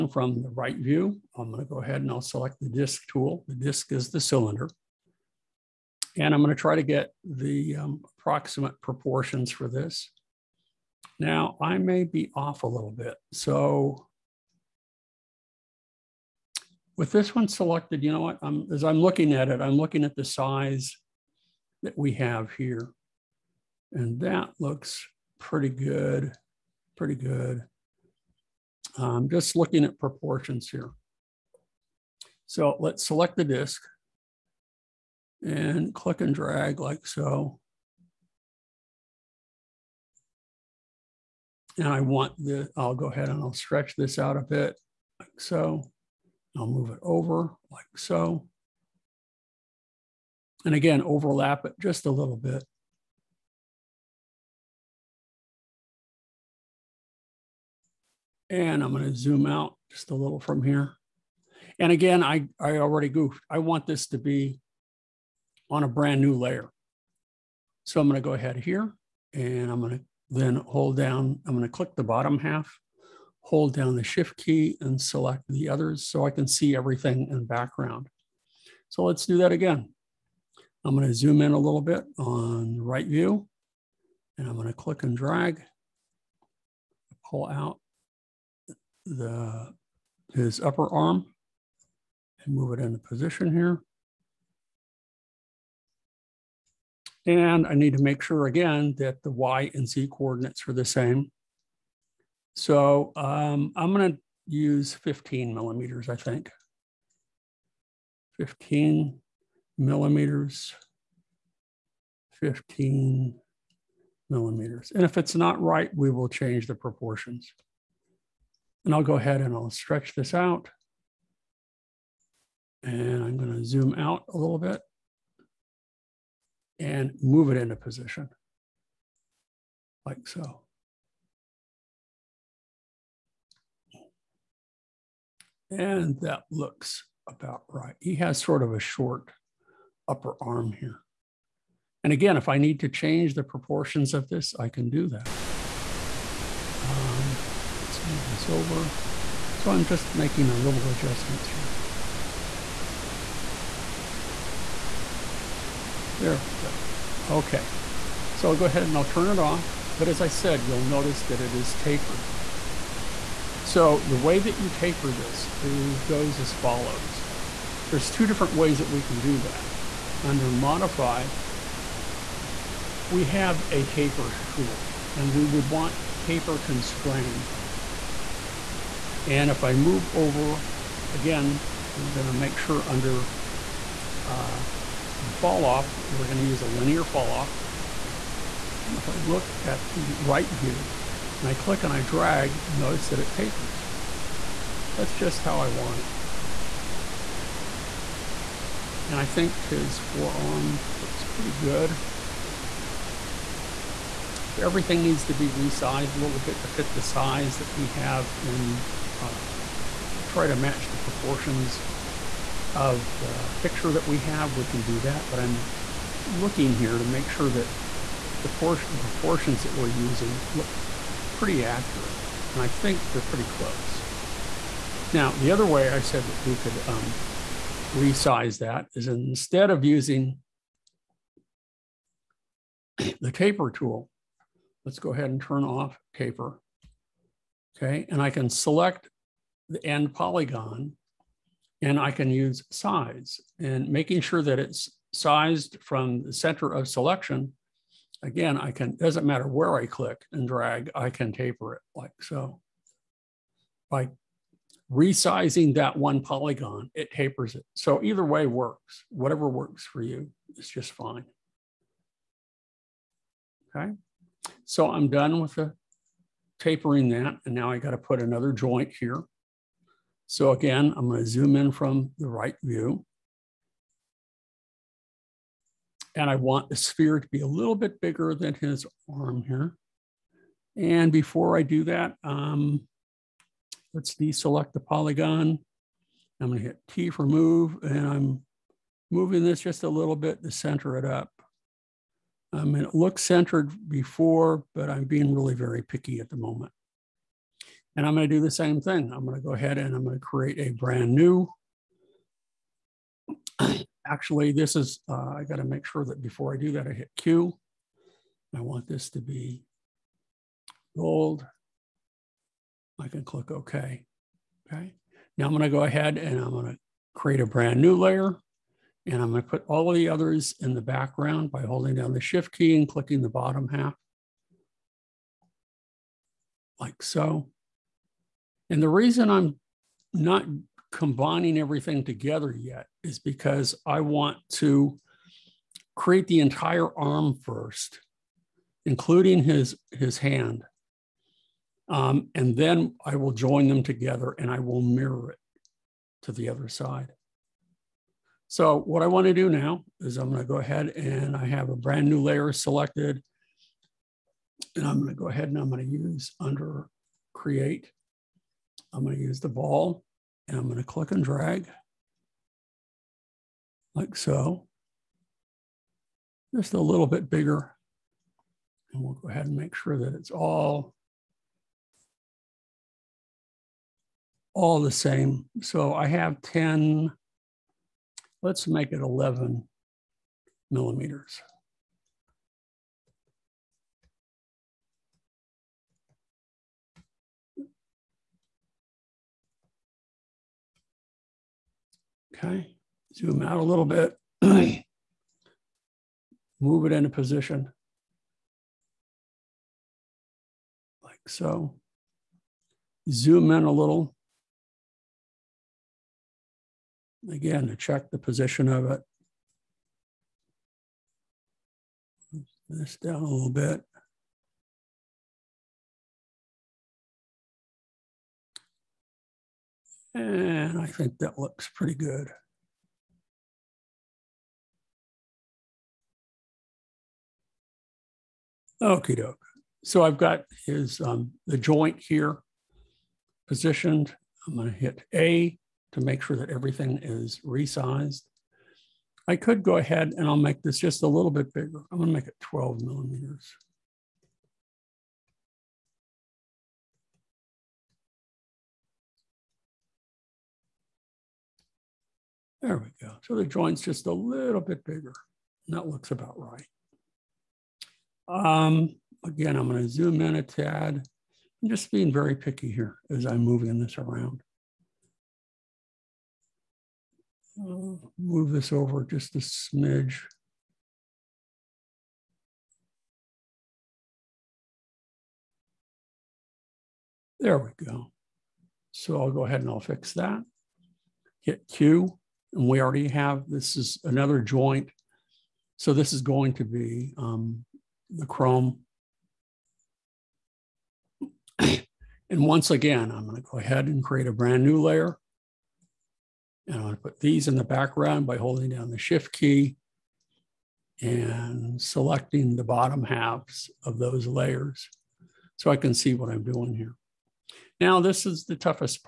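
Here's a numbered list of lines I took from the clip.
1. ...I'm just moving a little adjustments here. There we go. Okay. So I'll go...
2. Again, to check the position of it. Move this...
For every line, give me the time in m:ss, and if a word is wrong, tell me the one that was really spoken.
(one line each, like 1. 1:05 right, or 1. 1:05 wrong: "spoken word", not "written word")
1. 2:29 wrong: "making", not "moving"
2. 6:47 right.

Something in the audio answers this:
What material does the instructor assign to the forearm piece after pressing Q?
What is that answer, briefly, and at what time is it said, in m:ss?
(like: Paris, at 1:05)
gold, at 5:10.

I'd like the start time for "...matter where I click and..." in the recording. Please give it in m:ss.
4:09.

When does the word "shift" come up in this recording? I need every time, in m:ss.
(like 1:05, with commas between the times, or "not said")
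1:14, 5:22, 8:18.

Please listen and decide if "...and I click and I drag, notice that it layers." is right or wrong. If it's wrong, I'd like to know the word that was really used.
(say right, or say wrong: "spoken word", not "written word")
wrong: "tapers", not "layers".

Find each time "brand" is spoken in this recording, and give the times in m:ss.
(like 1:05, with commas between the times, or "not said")
1:05, 5:00, 5:17, 5:51, 8:14.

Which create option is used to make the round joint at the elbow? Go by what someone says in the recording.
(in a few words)
ball.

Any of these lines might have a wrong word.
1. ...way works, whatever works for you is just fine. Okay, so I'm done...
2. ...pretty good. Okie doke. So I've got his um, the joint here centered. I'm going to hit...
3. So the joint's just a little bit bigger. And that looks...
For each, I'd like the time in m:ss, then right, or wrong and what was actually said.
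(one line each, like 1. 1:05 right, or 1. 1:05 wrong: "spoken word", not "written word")
1. 4:18 right
2. 7:01 wrong: "positioned", not "centered"
3. 7:33 right.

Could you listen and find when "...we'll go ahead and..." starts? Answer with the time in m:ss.
6:09.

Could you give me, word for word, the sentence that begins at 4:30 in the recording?
So again, I'm gonna zoom in from the right view.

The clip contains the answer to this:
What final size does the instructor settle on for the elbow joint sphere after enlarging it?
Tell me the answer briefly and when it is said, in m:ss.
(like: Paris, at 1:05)
12 millimeters, at 7:22.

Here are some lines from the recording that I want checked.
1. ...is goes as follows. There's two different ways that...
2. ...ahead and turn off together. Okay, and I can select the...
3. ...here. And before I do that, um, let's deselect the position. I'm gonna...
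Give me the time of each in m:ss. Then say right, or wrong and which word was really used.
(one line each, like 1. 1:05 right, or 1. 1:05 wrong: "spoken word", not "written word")
1. 2:45 right
2. 3:55 wrong: "taper", not "together"
3. 4:39 wrong: "polygon", not "position".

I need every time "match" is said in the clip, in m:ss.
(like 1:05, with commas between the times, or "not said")
3:30.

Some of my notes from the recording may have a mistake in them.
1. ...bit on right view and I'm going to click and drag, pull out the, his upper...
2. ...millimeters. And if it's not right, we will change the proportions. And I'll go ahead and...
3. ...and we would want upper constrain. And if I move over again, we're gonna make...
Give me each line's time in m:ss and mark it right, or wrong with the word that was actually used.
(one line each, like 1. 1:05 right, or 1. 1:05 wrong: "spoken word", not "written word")
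1. 1:21 right
2. 1:54 right
3. 2:55 wrong: "taper", not "upper".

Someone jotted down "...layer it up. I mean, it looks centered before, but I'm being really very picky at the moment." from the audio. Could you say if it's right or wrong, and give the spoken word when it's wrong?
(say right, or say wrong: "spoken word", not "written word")
wrong: "center", not "layer".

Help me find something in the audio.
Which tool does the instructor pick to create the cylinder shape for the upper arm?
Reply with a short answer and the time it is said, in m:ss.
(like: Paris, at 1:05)
disk tool, at 0:02.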